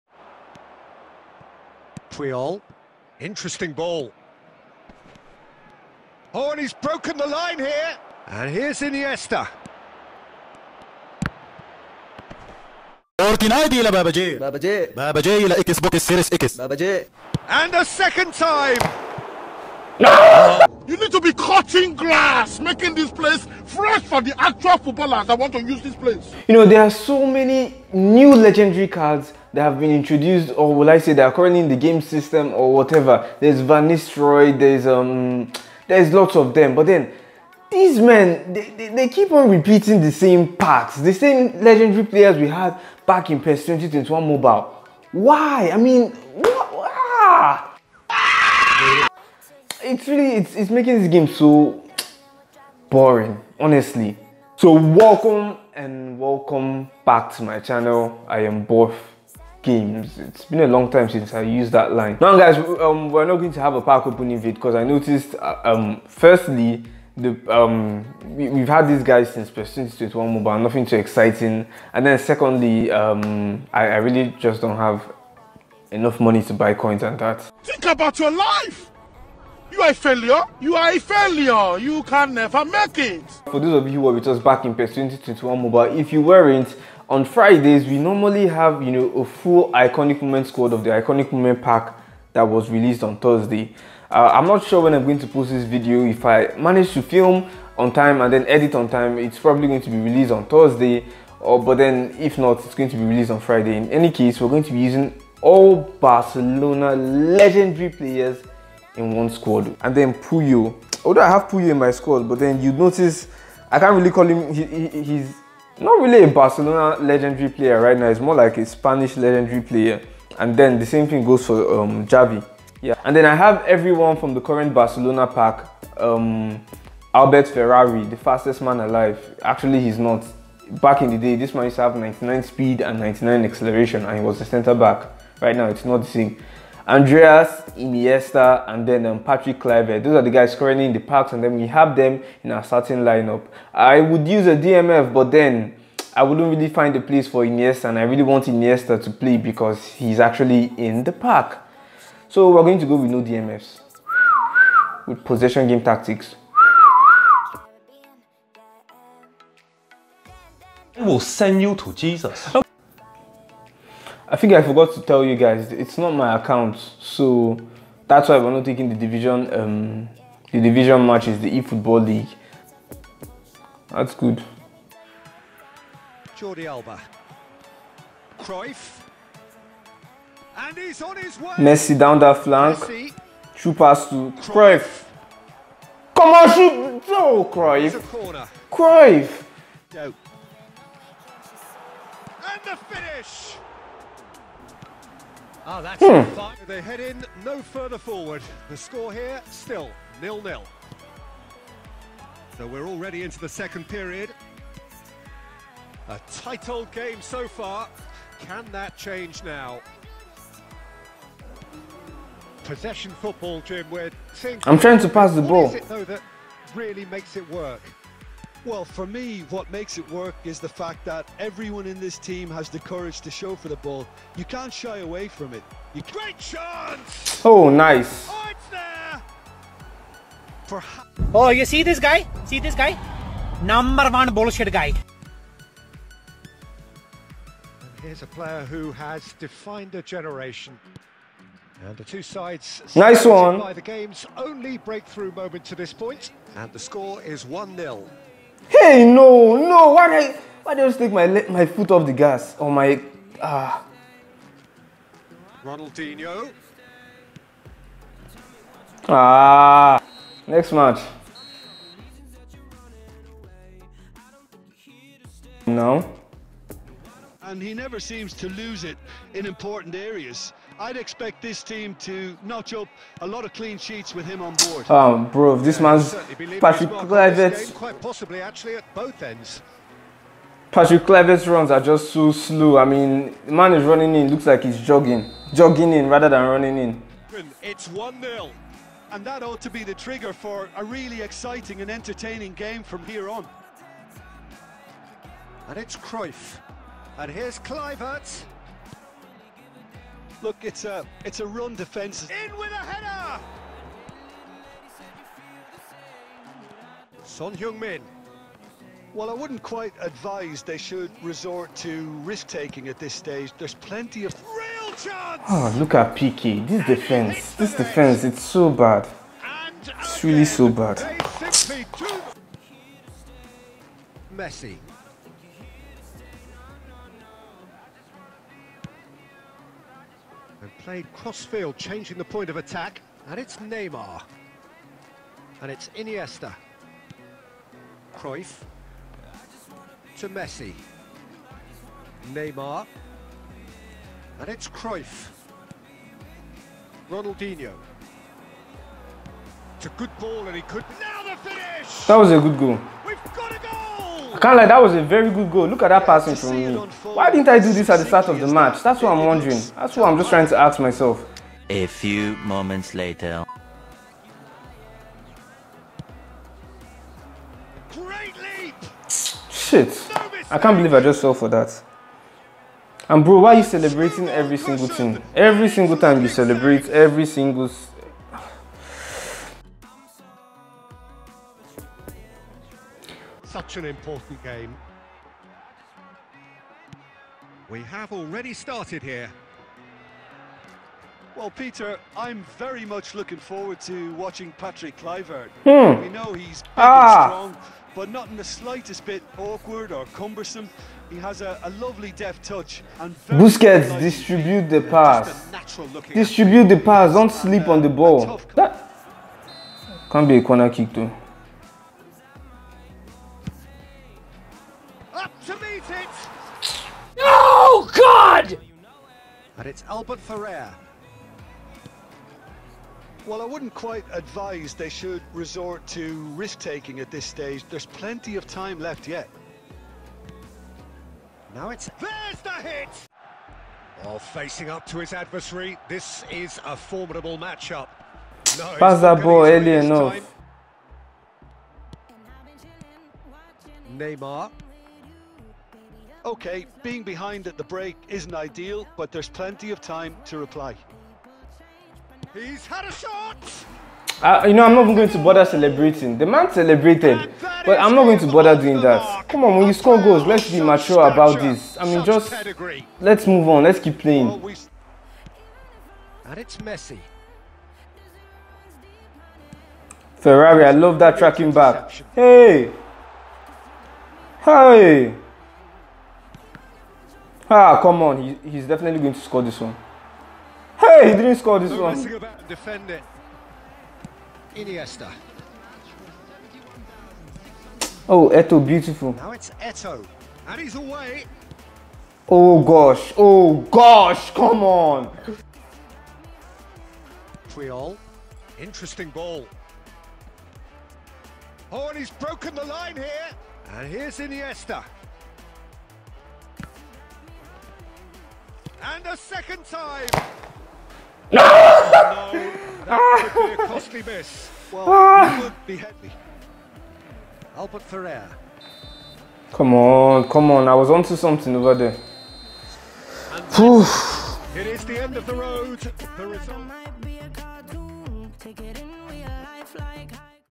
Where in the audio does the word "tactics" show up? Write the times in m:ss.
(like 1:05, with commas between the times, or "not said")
2:35.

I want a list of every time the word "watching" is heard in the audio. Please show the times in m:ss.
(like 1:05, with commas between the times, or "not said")
6:34.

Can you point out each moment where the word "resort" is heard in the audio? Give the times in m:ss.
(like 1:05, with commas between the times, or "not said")
5:11, 7:05.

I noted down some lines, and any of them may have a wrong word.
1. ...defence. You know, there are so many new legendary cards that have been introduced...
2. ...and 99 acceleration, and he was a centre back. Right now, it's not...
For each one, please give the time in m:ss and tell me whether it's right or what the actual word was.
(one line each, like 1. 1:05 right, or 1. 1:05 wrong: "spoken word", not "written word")
1. 0:25 wrong: "place", not "defence"
2. 2:12 right.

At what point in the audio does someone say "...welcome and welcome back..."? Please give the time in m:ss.
0:54.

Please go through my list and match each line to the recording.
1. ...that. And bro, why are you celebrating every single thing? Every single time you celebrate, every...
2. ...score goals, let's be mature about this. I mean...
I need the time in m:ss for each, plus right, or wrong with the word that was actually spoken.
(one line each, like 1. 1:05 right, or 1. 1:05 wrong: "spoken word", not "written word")
1. 6:11 right
2. 7:39 right.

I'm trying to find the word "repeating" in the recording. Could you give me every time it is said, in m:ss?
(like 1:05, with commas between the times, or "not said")
0:39.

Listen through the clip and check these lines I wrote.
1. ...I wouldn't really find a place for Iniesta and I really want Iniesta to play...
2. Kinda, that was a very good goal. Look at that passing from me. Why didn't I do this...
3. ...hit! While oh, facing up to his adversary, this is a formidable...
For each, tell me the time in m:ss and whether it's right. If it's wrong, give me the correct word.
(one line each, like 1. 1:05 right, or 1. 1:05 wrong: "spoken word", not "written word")
1. 2:26 right
2. 5:54 right
3. 7:12 right.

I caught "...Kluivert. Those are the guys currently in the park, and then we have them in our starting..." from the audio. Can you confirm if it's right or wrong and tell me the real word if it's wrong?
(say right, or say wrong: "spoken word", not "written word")
right.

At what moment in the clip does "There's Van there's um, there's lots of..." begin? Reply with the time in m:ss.
0:33.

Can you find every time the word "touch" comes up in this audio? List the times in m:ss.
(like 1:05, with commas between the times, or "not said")
6:42.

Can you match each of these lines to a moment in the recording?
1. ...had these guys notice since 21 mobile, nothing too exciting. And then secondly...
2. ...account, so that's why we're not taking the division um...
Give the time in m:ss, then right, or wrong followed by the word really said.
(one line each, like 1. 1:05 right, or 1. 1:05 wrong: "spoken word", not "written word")
1. 1:08 wrong: "since", not "notice"
2. 2:46 right.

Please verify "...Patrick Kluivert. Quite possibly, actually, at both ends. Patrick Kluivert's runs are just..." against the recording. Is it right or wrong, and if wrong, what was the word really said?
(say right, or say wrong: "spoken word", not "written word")
right.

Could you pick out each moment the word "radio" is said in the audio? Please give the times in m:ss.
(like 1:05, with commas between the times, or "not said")
not said.